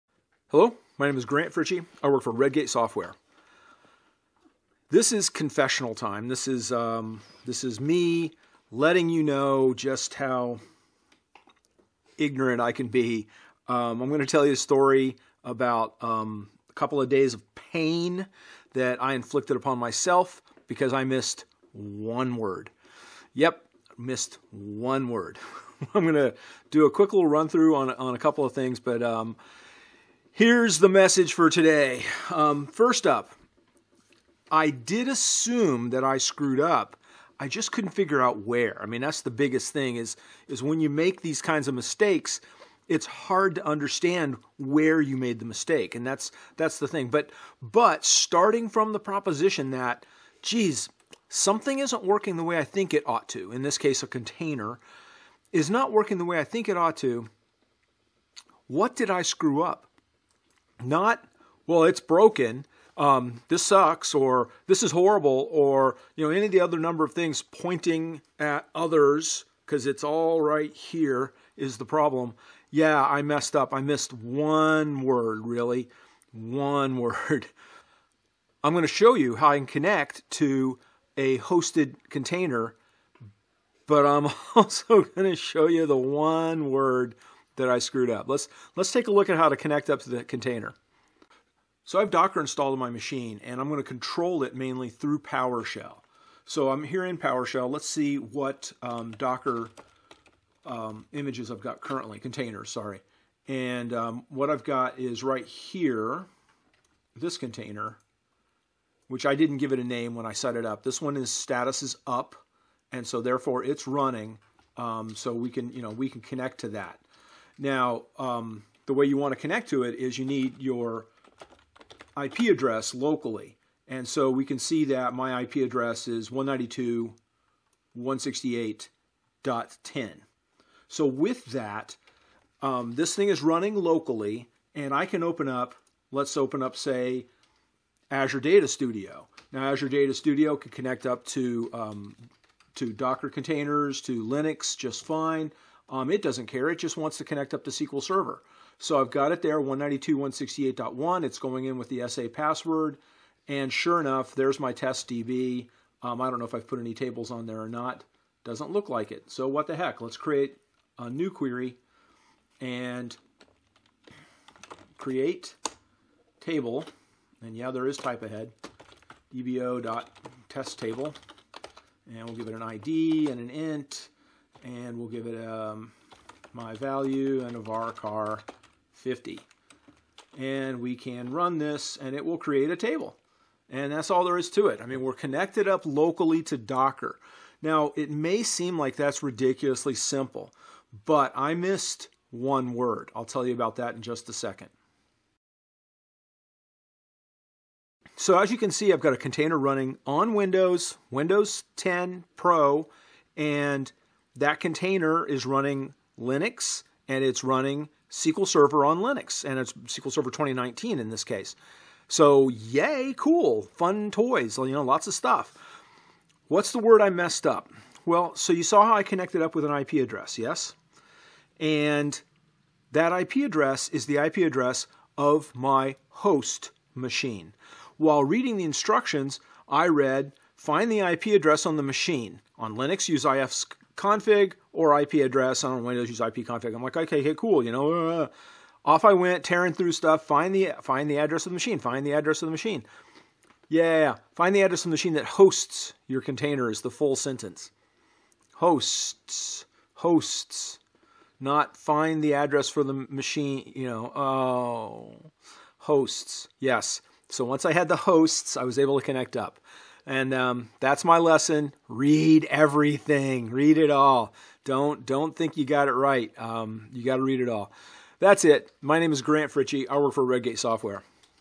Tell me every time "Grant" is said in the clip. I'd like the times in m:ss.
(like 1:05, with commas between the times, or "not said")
0:01, 4:29.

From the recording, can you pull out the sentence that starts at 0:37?
I just couldn't figure out where.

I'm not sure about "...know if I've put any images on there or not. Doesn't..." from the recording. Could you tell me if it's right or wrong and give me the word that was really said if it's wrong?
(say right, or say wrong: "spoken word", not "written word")
wrong: "tables", not "images".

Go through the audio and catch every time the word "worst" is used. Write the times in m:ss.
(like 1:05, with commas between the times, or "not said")
not said.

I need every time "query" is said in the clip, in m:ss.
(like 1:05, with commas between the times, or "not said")
2:41.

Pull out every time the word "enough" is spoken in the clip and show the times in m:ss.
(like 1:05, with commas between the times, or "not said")
2:33.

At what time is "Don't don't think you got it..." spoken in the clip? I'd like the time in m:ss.
4:24.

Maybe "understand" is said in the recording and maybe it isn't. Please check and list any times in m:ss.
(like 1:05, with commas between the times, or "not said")
0:43.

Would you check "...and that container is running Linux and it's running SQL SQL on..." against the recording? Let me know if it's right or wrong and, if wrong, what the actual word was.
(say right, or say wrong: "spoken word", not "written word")
wrong: "Server", not "SQL".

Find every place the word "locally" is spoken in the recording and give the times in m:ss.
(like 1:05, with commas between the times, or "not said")
2:02, 2:13, 3:05.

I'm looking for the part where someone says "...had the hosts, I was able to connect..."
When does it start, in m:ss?
4:17.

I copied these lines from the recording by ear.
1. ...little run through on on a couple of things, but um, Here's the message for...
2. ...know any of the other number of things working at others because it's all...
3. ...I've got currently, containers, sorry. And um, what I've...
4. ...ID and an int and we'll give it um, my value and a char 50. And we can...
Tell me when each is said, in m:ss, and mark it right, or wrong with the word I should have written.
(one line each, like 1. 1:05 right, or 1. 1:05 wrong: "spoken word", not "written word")
1. 0:27 right
2. 1:06 wrong: "pointing", not "working"
3. 1:41 right
4. 2:52 right.